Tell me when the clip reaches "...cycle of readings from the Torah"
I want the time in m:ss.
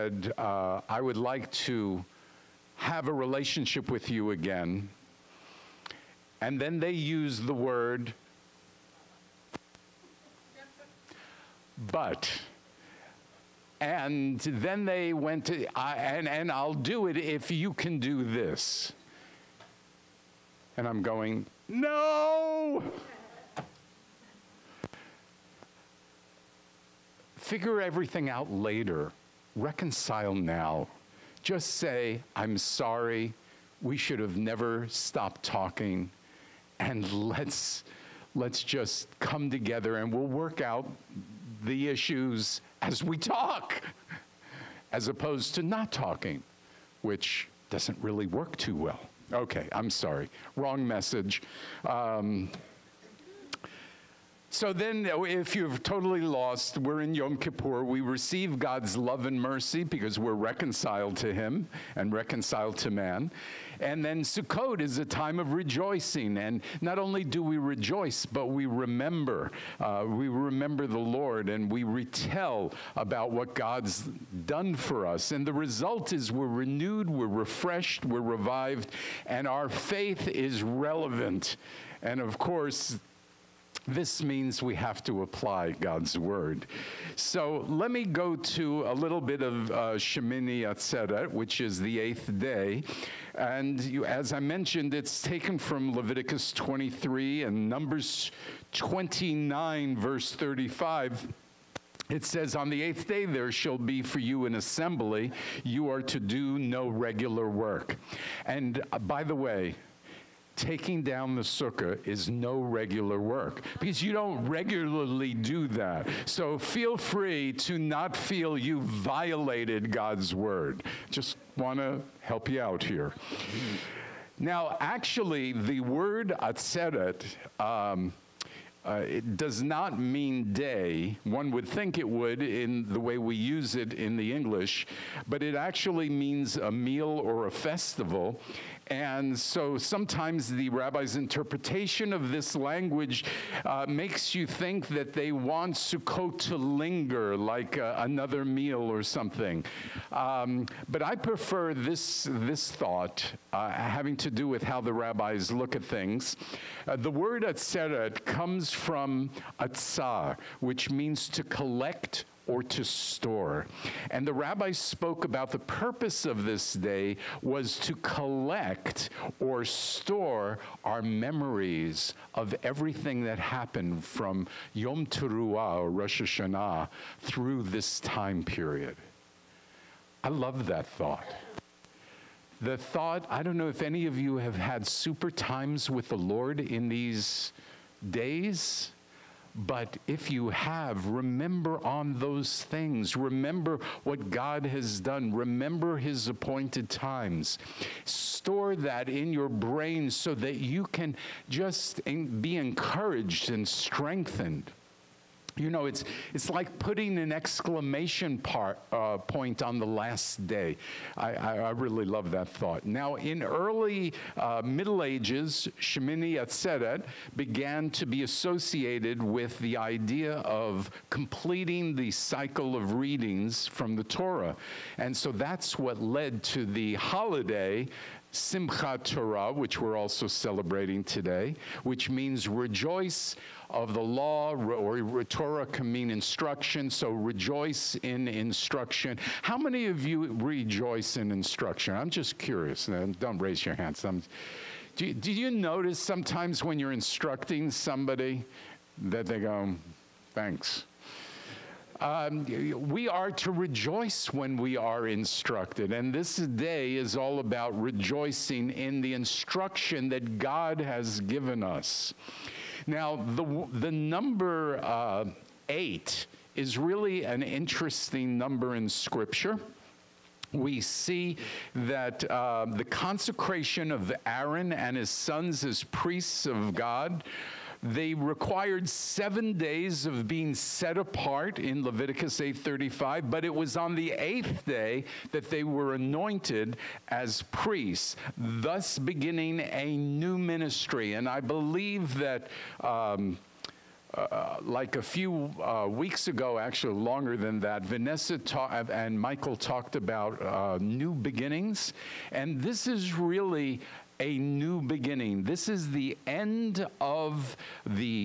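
3:42.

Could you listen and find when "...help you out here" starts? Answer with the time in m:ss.
2:02.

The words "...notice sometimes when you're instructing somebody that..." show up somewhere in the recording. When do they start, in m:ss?
4:05.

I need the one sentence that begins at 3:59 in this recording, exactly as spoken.
How many of you rejoice in instruction?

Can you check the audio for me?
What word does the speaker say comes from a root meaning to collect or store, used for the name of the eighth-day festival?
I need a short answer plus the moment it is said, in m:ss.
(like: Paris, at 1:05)
atzah, at 2:39.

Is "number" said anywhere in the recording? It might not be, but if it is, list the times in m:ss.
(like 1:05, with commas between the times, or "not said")
1:37, 4:23, 4:28.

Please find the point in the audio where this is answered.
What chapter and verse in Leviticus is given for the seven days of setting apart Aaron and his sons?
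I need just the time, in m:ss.
4:41.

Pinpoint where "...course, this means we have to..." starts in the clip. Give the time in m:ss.
1:22.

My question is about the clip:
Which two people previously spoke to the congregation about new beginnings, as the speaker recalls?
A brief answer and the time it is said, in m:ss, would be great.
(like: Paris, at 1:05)
Vanessa and Michael, at 4:57.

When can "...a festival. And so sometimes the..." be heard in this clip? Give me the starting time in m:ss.
2:17.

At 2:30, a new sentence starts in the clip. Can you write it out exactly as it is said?
Um, but I prefer this, this thought uh, having to do with how the rabbis look at things.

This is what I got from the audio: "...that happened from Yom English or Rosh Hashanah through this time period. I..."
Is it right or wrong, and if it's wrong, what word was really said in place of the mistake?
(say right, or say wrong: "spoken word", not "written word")
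wrong: "Teruah", not "English".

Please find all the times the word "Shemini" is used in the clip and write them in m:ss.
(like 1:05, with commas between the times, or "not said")
1:29, 3:35.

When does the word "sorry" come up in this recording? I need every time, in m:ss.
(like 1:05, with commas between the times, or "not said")
0:32, 0:49.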